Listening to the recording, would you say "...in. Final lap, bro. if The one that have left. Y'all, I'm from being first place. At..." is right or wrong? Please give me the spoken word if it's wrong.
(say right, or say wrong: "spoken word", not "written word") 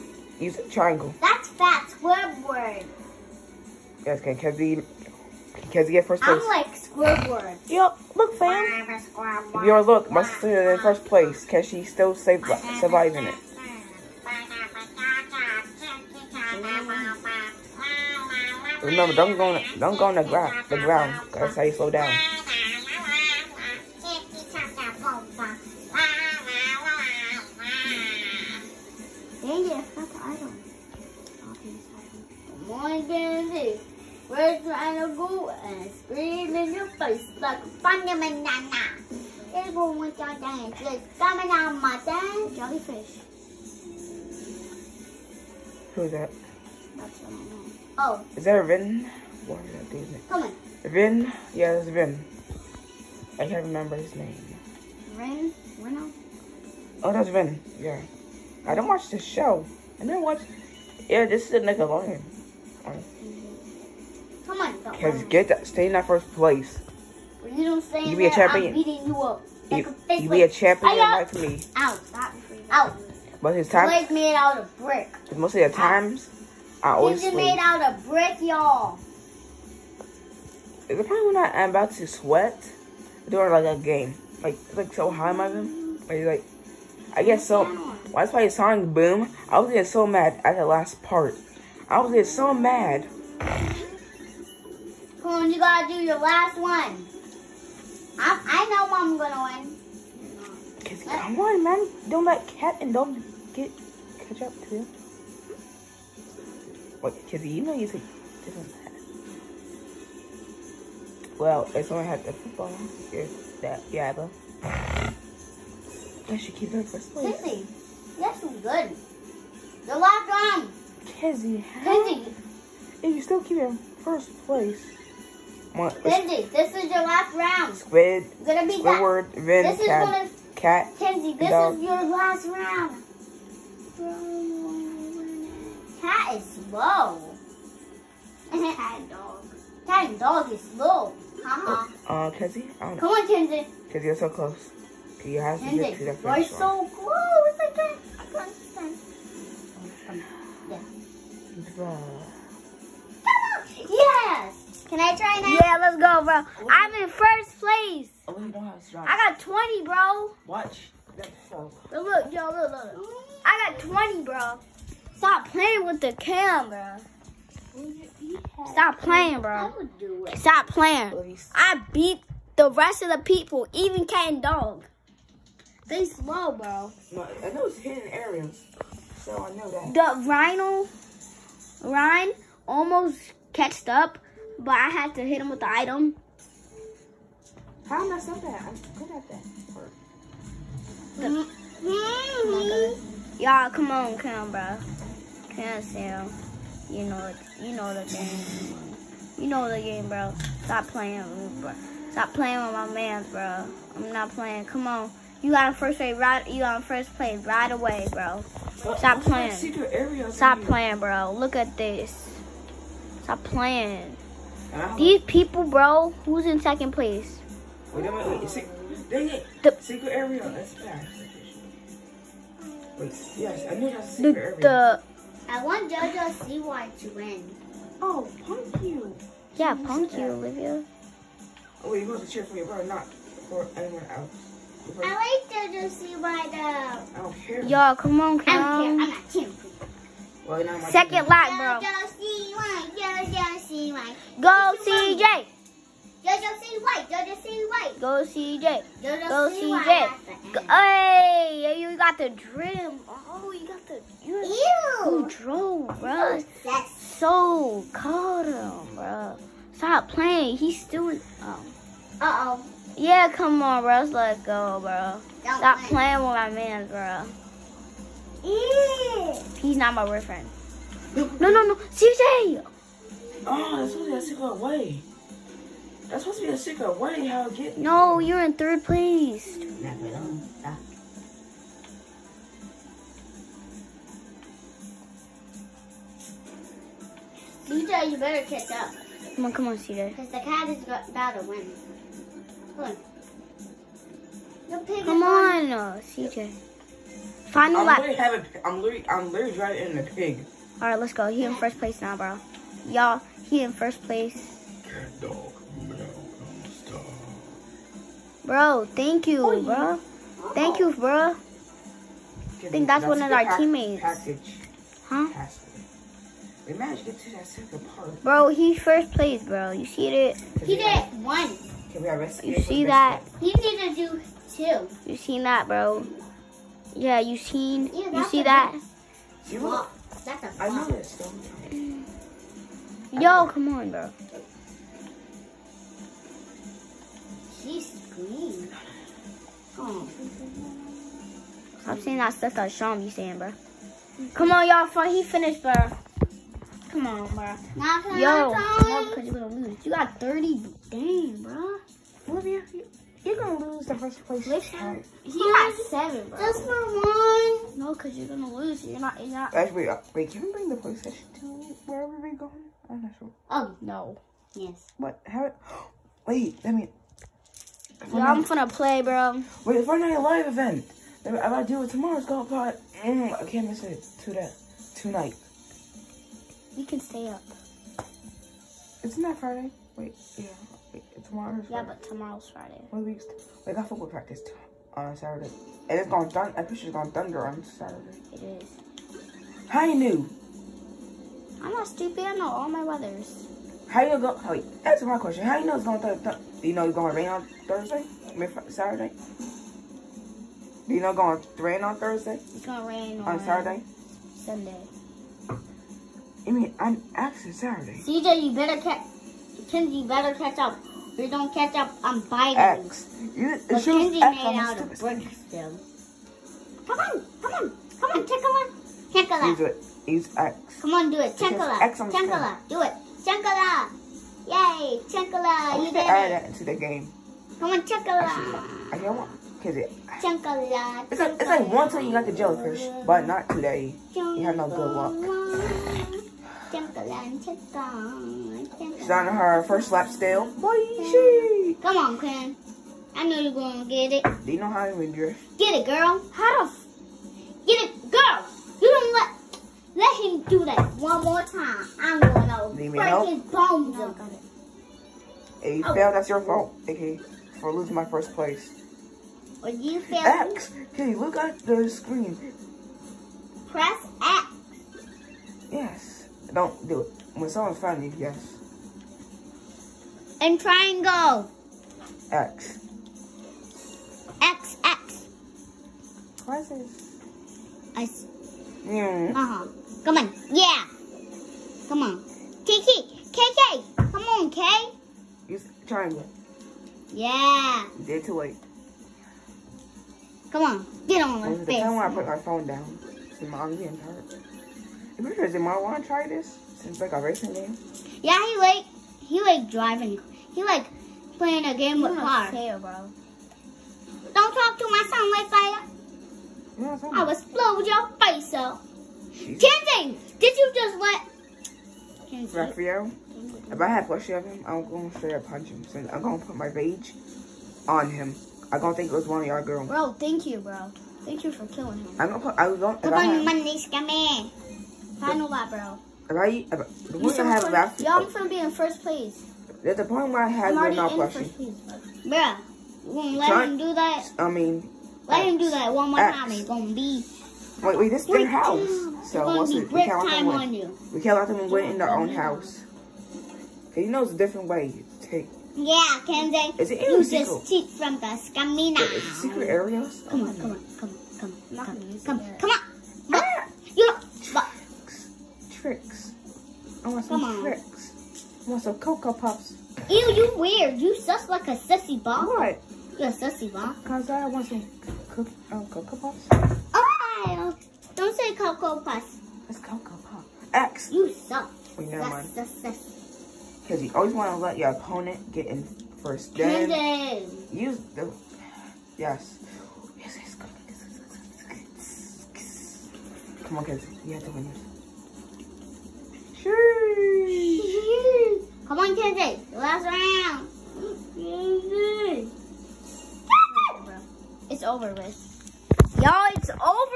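right.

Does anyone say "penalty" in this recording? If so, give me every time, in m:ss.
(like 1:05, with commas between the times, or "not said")
not said.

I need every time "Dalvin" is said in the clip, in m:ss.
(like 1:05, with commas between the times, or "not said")
not said.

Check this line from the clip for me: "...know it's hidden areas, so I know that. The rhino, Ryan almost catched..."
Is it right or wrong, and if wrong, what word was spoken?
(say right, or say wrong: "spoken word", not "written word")
right.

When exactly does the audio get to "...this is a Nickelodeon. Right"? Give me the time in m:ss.
1:01.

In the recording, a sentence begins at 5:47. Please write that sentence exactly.
Not Yo, because you're gonna lose.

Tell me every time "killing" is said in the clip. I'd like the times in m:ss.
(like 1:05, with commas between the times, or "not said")
8:41.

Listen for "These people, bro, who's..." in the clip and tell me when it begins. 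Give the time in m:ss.
3:34.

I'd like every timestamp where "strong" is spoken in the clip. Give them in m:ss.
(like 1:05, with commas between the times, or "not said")
2:38.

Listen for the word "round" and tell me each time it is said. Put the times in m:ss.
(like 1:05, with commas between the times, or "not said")
2:07, 2:12, 9:50.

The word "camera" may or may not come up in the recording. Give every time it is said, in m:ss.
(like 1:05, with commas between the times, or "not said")
2:46, 3:14.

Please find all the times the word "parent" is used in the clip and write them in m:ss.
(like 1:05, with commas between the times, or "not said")
not said.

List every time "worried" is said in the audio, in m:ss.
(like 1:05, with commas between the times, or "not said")
not said.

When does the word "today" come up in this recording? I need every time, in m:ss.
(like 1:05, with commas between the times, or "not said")
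7:13.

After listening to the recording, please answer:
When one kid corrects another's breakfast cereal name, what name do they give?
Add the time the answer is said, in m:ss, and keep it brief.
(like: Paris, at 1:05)
Cocoa Pops, at 9:29.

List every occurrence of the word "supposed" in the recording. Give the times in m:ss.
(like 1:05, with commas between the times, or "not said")
3:52, 4:36.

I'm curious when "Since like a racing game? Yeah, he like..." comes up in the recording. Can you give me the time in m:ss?
8:16.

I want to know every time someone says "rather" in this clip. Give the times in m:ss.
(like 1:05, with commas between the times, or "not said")
not said.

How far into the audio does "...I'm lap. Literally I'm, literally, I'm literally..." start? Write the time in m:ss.
4:57.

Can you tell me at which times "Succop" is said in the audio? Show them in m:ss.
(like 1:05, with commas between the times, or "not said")
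not said.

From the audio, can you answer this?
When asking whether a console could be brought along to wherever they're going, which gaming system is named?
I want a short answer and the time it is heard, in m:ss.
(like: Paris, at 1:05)
PlayStation, at 6:00.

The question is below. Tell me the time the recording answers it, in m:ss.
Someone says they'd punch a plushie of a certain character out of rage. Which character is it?
8:32.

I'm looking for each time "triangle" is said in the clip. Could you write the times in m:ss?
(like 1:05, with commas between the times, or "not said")
0:00, 7:50.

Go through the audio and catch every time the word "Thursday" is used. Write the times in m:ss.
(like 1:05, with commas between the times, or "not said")
6:37, 6:41.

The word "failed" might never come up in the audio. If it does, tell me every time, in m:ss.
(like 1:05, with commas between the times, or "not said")
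7:35, 7:40.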